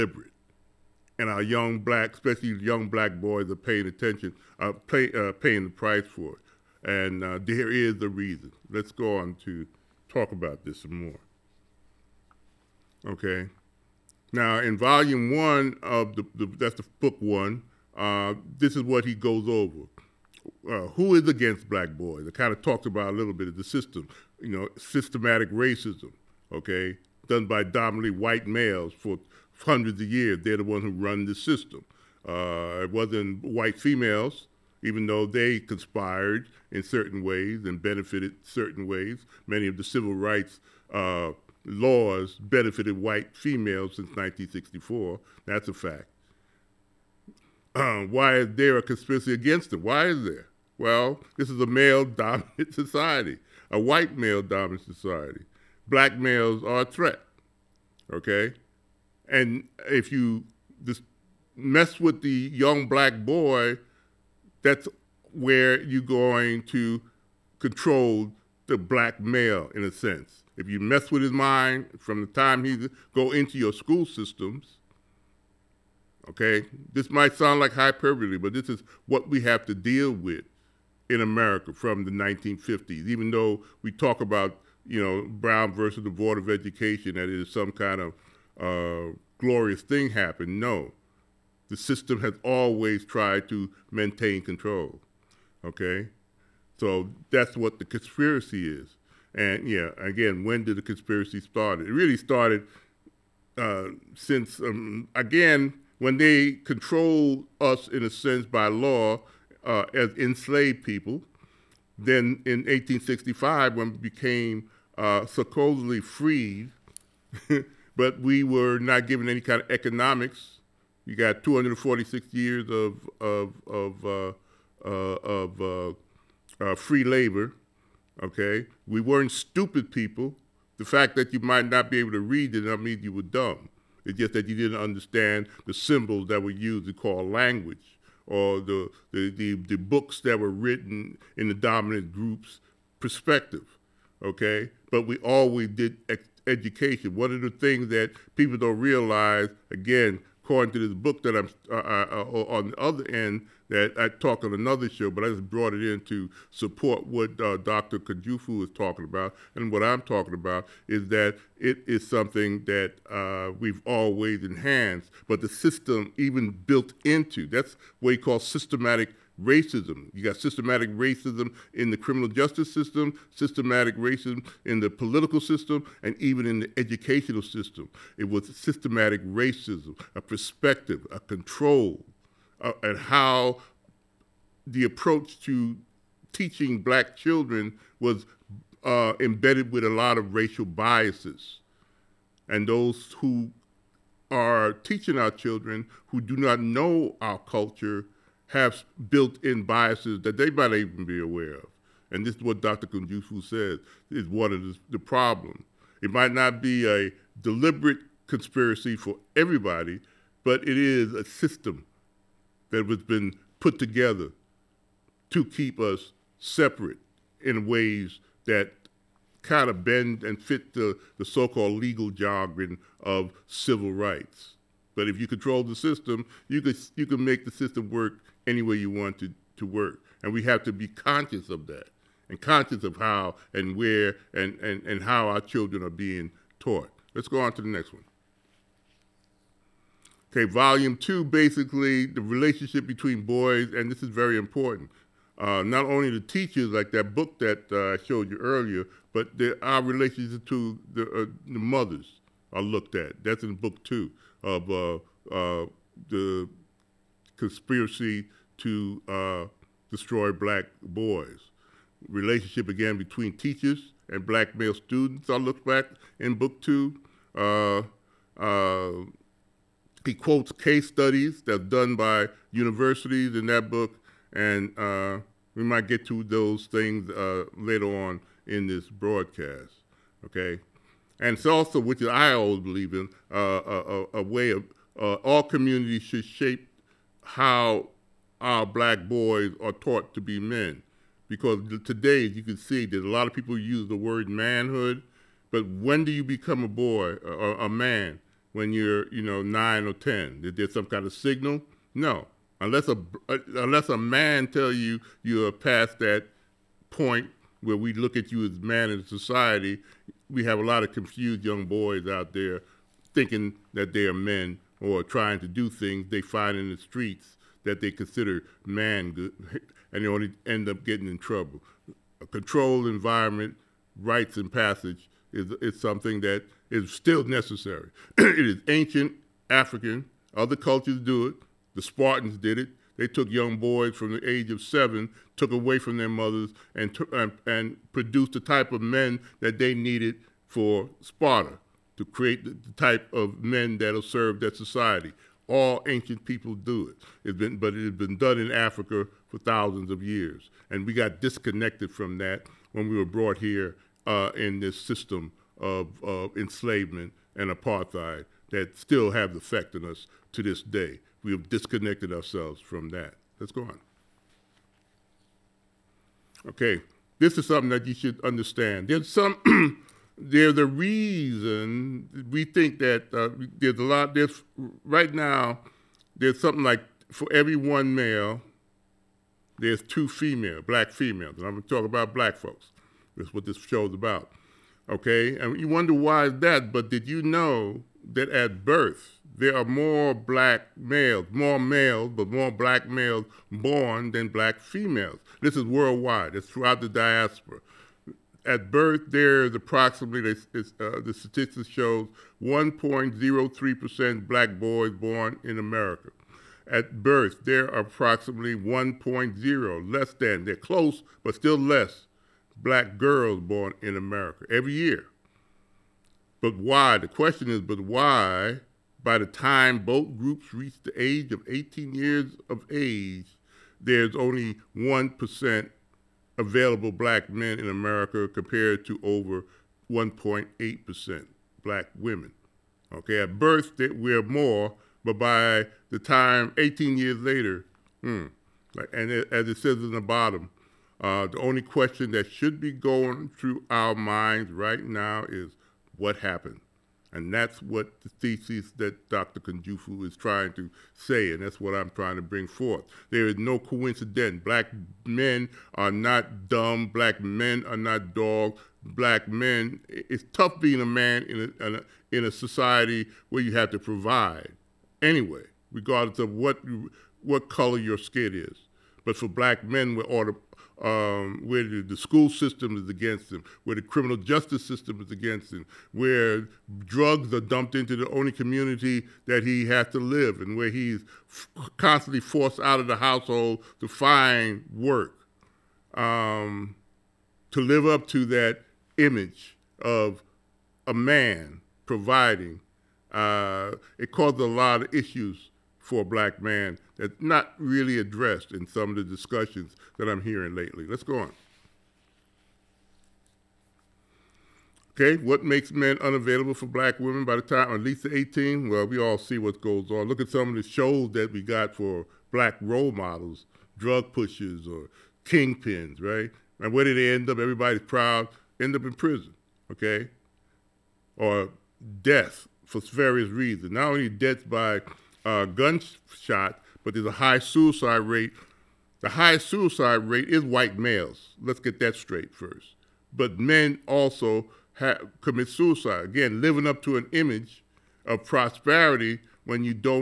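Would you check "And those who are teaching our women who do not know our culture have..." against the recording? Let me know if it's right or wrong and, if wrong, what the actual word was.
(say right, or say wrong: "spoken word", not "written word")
wrong: "children", not "women".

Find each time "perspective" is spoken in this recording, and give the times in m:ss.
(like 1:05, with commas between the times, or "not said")
2:22, 3:00.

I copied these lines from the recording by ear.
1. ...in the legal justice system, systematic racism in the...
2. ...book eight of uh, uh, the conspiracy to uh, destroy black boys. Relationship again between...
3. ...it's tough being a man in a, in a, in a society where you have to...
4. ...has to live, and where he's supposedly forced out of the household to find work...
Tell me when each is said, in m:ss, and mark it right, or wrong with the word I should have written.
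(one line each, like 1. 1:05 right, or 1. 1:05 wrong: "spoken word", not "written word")
1. 2:51 wrong: "criminal", not "legal"
2. 4:13 wrong: "two", not "eight"
3. 7:39 right
4. 7:59 wrong: "constantly", not "supposedly".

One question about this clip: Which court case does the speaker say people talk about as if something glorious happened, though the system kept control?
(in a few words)
Brown versus the Board of Education.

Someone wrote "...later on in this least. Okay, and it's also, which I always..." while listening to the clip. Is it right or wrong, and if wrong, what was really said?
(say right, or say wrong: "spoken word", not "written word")
wrong: "broadcast", not "least".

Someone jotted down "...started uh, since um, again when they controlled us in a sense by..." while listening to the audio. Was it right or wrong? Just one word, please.
right.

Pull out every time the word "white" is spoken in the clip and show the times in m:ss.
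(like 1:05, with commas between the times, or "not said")
0:28, 0:33, 0:42, 0:53, 8:50.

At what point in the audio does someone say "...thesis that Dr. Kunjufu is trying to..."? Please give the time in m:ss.
7:28.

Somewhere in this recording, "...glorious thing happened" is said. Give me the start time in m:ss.
1:29.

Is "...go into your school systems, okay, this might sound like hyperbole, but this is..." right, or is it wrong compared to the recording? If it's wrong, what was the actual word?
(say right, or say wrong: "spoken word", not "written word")
right.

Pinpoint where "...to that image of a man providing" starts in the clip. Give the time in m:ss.
8:08.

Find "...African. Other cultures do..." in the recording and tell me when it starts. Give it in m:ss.
5:29.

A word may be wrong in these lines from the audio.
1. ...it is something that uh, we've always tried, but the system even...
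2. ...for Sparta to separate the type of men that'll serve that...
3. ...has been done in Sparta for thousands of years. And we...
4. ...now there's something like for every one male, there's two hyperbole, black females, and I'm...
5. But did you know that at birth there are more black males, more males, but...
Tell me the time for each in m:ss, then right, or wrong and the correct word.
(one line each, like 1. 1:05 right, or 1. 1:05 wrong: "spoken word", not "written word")
1. 2:41 wrong: "enhanced", not "tried"
2. 5:40 wrong: "create", not "separate"
3. 5:47 wrong: "Africa", not "Sparta"
4. 6:15 wrong: "female", not "hyperbole"
5. 6:26 right.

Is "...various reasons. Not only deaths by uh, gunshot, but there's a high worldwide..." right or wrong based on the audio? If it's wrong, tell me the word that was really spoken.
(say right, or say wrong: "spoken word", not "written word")
wrong: "suicide", not "worldwide".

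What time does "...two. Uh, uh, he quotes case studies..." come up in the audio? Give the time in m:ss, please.
4:26.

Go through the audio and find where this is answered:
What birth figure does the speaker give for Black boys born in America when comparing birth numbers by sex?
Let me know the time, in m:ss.
6:42.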